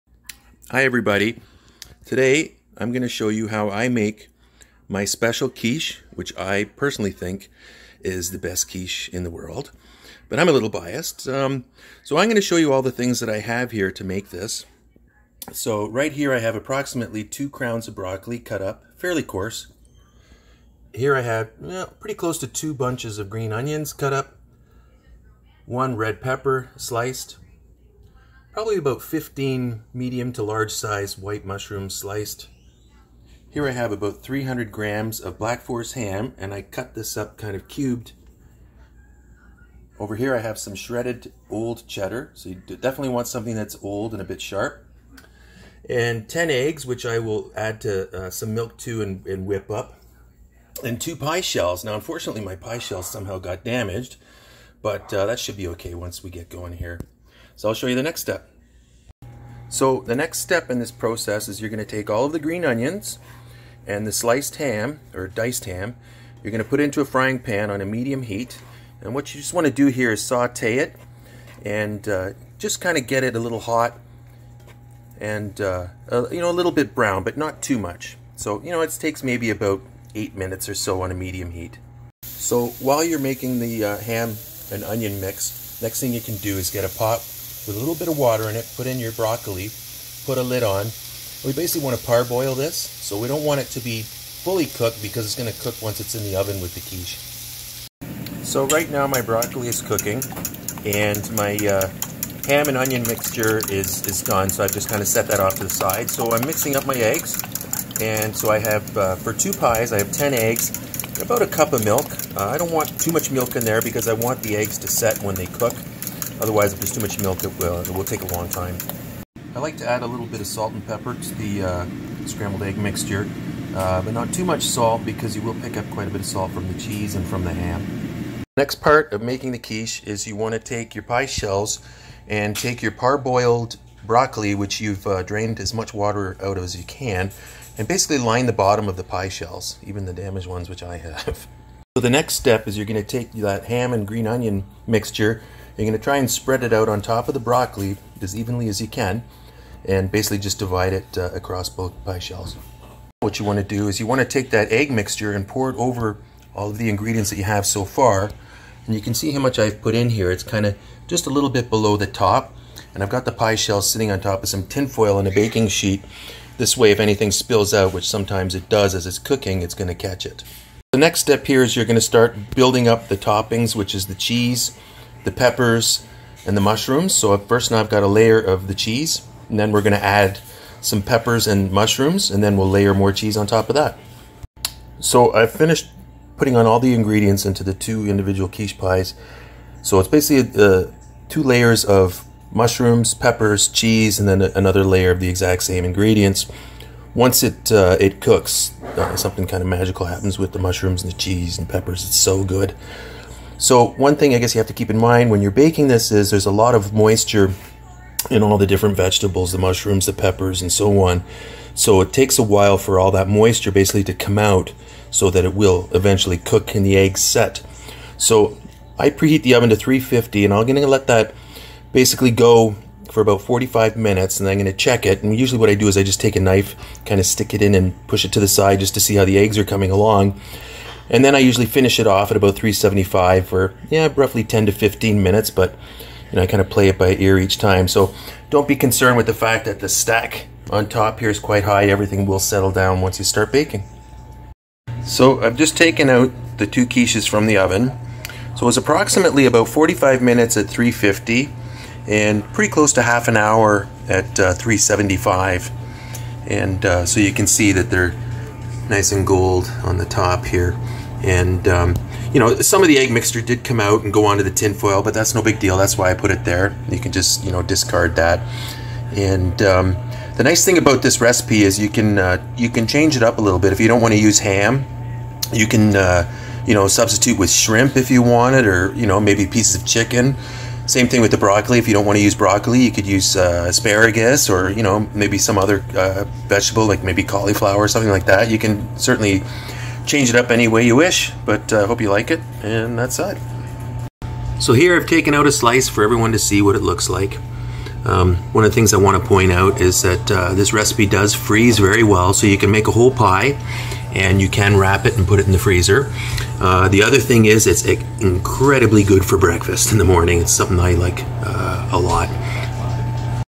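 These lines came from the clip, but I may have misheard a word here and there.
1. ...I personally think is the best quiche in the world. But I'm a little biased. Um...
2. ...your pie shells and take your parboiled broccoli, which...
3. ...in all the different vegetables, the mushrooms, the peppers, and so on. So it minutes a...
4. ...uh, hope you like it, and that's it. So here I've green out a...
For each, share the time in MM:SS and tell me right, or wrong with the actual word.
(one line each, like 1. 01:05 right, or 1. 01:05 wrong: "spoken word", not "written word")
1. 00:06 right
2. 02:10 right
3. 03:28 wrong: "takes", not "minutes"
4. 04:51 wrong: "taken", not "green".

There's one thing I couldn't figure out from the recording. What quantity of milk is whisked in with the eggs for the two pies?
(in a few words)
a cup.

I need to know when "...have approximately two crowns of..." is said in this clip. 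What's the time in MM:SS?
00:16.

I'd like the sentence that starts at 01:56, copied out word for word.
Otherwise, if there's too much milk, it will, it will take a long time.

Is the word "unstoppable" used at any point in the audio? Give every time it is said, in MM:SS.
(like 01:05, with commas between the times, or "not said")
not said.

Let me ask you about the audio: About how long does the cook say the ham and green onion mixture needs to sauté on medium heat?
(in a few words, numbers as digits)
8 minutes.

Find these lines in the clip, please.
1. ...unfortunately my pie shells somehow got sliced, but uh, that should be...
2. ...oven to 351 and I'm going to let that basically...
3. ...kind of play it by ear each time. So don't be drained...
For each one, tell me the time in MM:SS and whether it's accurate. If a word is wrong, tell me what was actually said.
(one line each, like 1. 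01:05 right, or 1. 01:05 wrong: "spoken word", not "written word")
1. 00:51 wrong: "damaged", not "sliced"
2. 03:39 wrong: "350", not "351"
3. 03:56 wrong: "concerned", not "drained".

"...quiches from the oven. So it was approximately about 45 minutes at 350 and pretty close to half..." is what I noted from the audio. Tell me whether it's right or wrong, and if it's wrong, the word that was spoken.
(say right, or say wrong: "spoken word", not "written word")
right.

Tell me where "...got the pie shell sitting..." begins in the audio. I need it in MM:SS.
02:43.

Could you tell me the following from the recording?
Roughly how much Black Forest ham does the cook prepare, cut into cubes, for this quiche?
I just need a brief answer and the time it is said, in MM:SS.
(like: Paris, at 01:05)
300 grams, at 00:34.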